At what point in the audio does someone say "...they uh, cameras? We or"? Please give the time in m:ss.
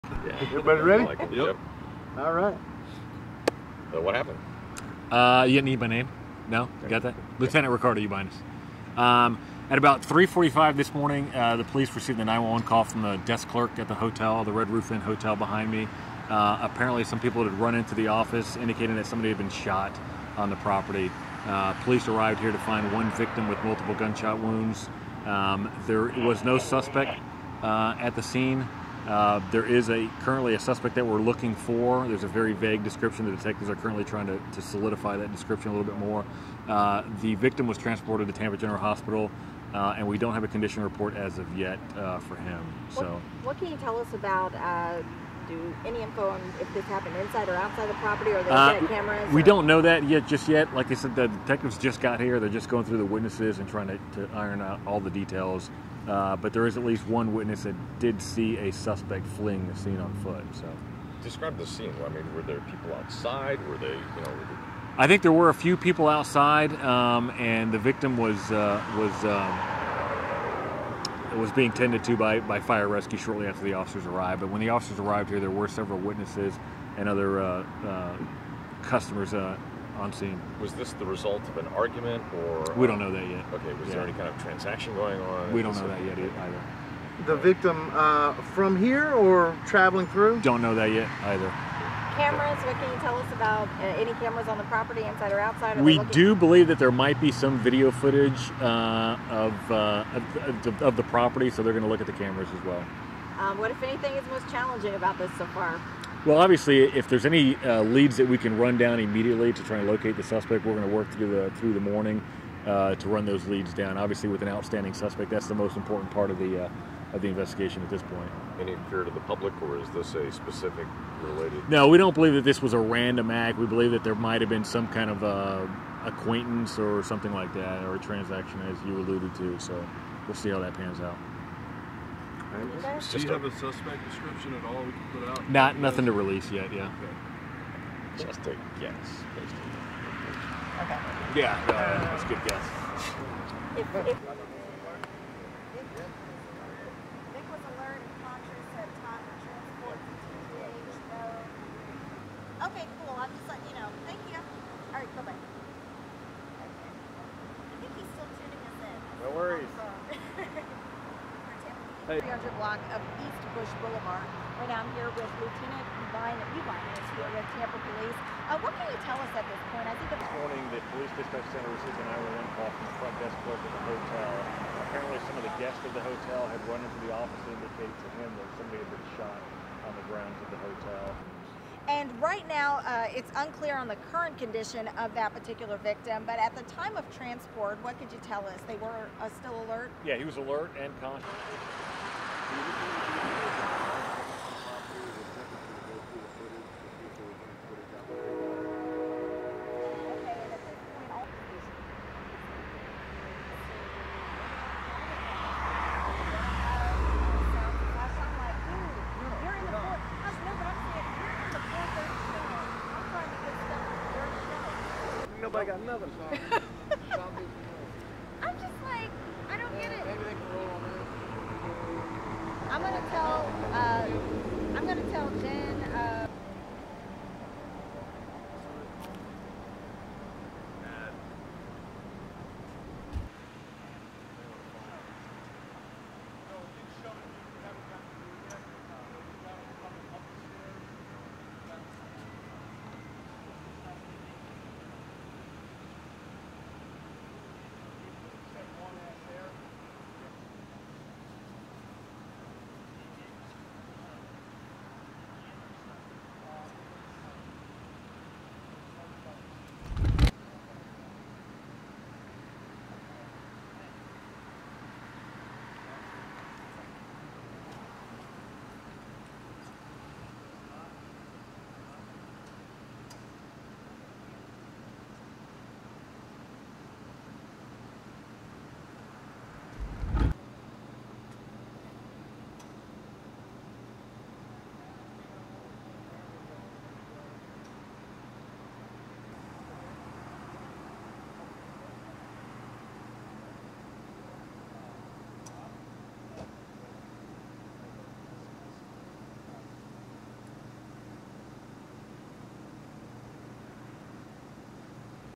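0:48.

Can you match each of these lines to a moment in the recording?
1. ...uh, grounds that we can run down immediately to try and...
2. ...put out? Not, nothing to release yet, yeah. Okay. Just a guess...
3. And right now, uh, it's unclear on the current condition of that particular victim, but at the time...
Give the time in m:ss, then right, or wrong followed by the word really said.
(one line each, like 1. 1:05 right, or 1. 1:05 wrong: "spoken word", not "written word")
1. 1:47 wrong: "leads", not "grounds"
2. 2:15 right
3. 3:01 right.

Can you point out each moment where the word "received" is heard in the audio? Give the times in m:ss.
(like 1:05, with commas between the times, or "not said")
0:11, 2:51.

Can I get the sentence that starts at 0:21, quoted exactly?
Uh, police arrived here to find one victim with multiple gunshot wounds.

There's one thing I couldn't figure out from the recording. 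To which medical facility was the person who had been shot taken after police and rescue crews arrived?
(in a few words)
Tampa General Hospital.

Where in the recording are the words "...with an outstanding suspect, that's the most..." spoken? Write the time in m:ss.
1:54.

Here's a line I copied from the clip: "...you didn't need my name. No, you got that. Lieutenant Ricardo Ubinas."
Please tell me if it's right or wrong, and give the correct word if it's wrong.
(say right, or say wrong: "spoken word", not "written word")
right.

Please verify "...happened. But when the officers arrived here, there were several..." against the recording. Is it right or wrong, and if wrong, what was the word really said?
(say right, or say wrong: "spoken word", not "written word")
wrong: "arrived", not "happened".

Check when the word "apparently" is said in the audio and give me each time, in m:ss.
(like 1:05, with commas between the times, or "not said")
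0:16, 2:54.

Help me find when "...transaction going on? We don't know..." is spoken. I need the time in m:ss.
1:24.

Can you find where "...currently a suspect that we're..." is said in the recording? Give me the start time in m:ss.
0:30.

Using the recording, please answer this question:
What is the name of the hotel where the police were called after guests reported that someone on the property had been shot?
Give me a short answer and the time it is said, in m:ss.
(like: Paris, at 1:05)
Red Roof Inn, at 0:14.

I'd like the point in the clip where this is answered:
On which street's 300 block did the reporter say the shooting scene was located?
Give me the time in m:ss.
2:43.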